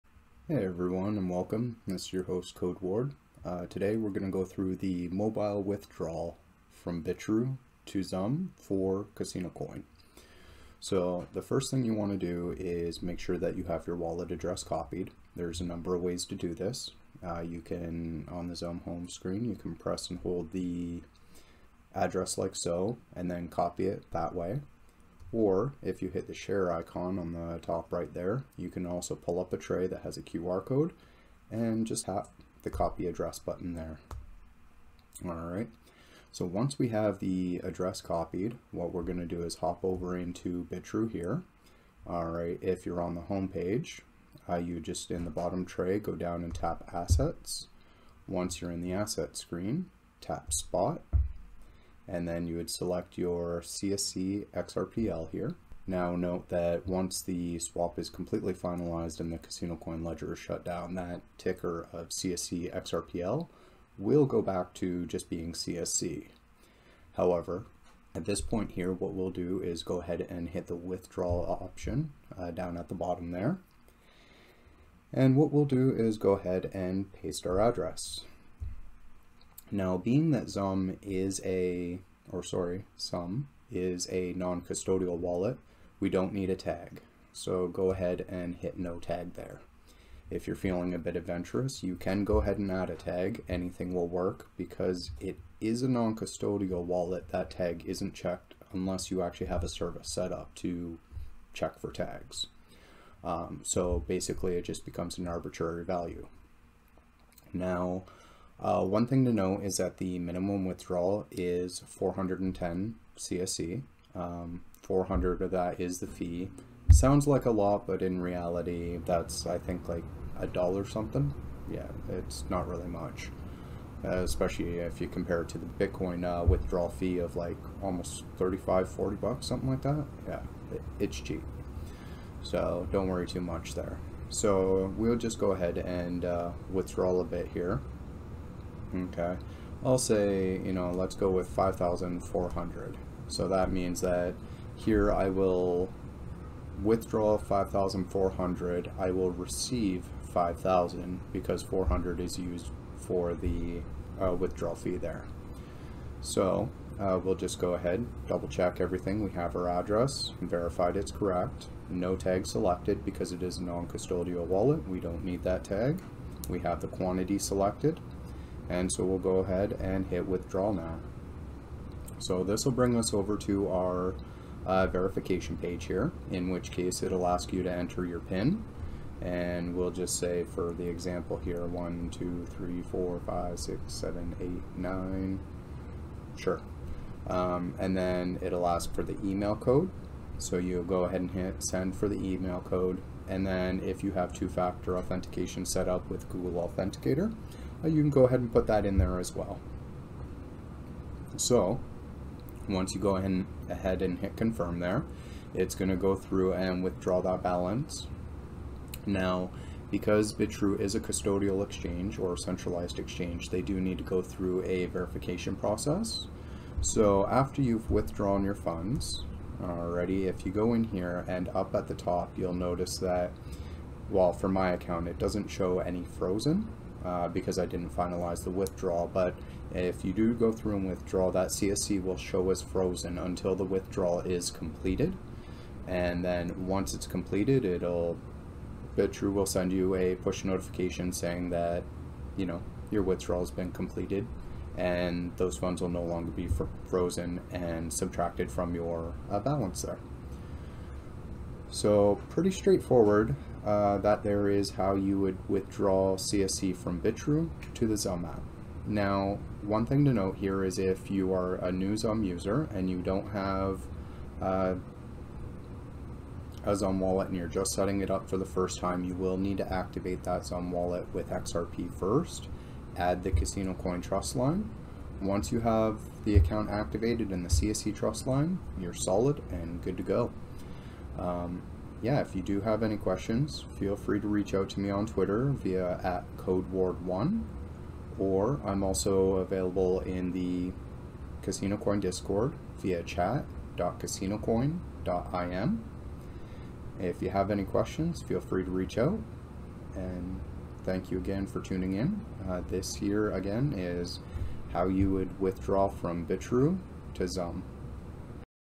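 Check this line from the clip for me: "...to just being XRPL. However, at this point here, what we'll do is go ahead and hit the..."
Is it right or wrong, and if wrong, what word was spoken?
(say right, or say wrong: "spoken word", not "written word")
wrong: "CSC", not "XRPL".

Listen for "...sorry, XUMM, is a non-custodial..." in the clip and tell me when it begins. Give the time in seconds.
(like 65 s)
82 s.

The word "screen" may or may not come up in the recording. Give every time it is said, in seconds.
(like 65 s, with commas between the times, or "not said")
19 s, 49 s.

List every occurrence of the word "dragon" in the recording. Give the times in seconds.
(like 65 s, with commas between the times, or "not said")
not said.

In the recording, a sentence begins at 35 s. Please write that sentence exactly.
All right, so once we have the address copied, what we're gonna do is hop over into Bitrue here.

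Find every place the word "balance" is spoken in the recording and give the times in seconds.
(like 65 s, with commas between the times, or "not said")
207 s, 249 s.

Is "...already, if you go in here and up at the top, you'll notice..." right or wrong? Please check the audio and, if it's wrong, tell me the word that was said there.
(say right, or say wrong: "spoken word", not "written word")
right.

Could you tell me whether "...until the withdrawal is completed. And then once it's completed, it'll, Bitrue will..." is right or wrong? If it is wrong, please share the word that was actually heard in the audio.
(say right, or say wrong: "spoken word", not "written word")
right.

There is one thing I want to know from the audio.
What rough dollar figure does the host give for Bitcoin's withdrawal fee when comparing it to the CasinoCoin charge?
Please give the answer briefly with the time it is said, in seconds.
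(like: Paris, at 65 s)
35, 40 bucks, at 128 s.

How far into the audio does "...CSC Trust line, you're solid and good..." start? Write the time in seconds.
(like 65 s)
277 s.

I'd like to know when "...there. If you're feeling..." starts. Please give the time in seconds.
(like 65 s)
89 s.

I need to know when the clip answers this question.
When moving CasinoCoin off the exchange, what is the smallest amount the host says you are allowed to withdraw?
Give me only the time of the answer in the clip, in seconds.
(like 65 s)
111 s.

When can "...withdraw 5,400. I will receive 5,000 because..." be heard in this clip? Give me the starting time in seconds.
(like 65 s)
146 s.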